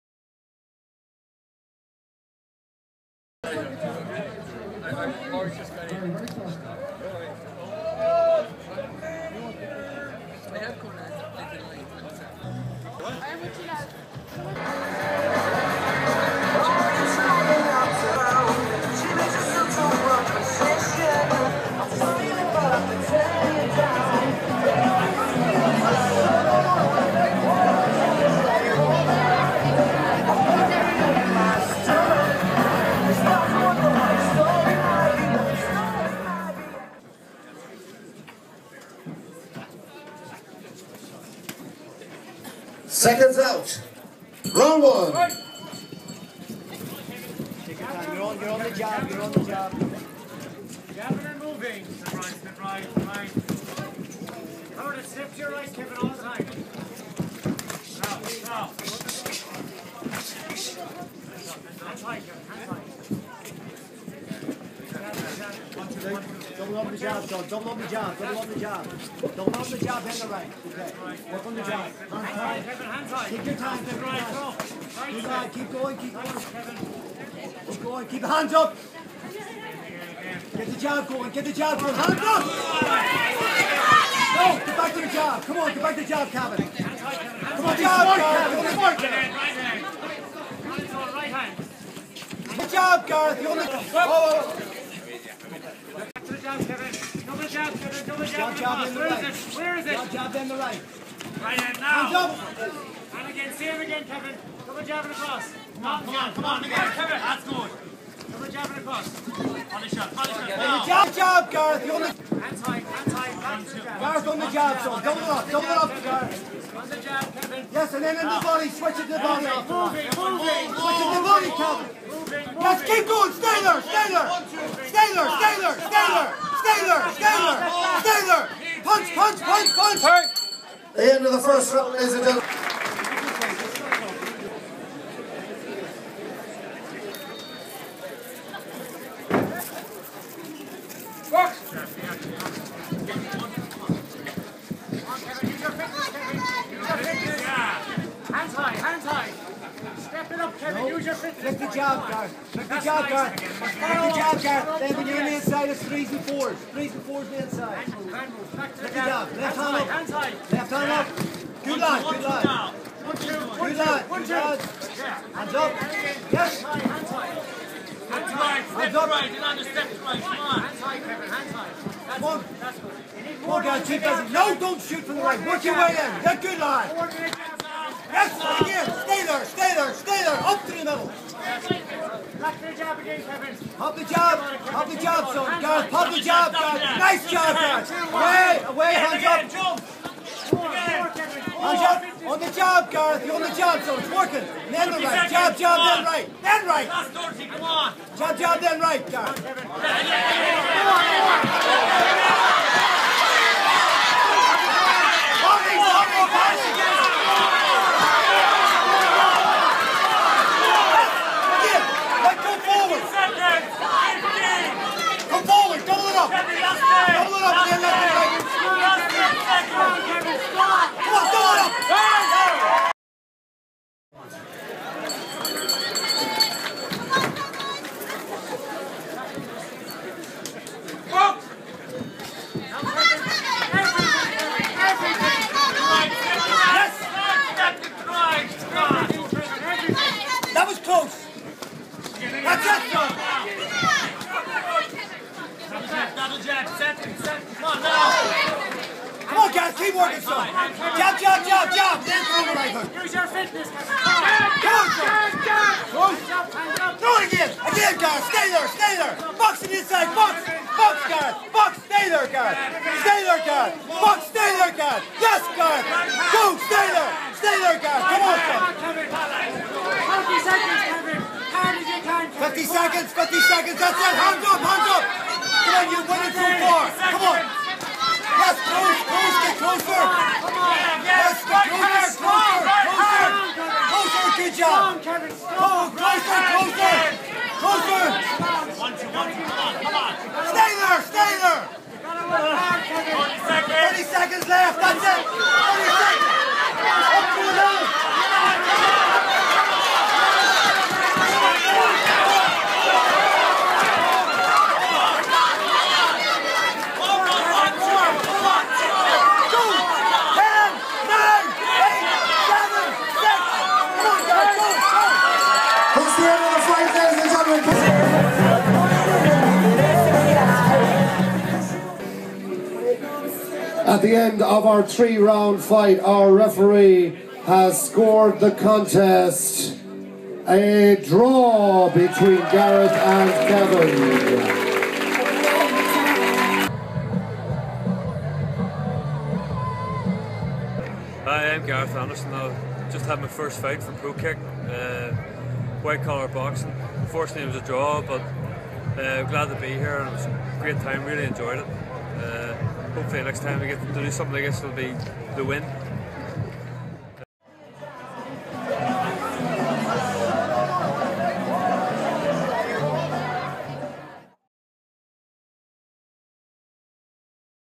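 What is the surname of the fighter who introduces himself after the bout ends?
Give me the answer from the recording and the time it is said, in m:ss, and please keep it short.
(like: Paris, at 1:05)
Anderson, at 5:41.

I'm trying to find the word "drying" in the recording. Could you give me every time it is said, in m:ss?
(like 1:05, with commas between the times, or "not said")
not said.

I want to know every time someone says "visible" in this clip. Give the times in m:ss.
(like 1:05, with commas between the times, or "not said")
not said.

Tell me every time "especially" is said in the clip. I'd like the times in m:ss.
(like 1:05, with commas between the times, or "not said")
not said.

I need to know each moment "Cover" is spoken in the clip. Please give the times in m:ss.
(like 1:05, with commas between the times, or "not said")
0:54.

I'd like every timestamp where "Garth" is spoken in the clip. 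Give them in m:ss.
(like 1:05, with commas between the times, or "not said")
1:33, 3:12.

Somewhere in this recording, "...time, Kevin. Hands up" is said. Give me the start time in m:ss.
1:13.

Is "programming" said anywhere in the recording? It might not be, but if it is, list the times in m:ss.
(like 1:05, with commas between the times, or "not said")
not said.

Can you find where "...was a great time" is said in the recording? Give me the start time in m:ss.
5:50.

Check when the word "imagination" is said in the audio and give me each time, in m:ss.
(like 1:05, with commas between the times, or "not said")
not said.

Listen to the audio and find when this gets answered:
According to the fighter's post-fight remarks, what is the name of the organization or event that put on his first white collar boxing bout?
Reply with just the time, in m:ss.
5:43.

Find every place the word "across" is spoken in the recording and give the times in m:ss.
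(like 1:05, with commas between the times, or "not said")
1:45.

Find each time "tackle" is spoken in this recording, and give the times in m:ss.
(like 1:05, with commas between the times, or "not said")
not said.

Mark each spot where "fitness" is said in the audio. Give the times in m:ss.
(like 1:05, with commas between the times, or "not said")
2:31, 4:13.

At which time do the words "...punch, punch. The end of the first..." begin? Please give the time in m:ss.
2:09.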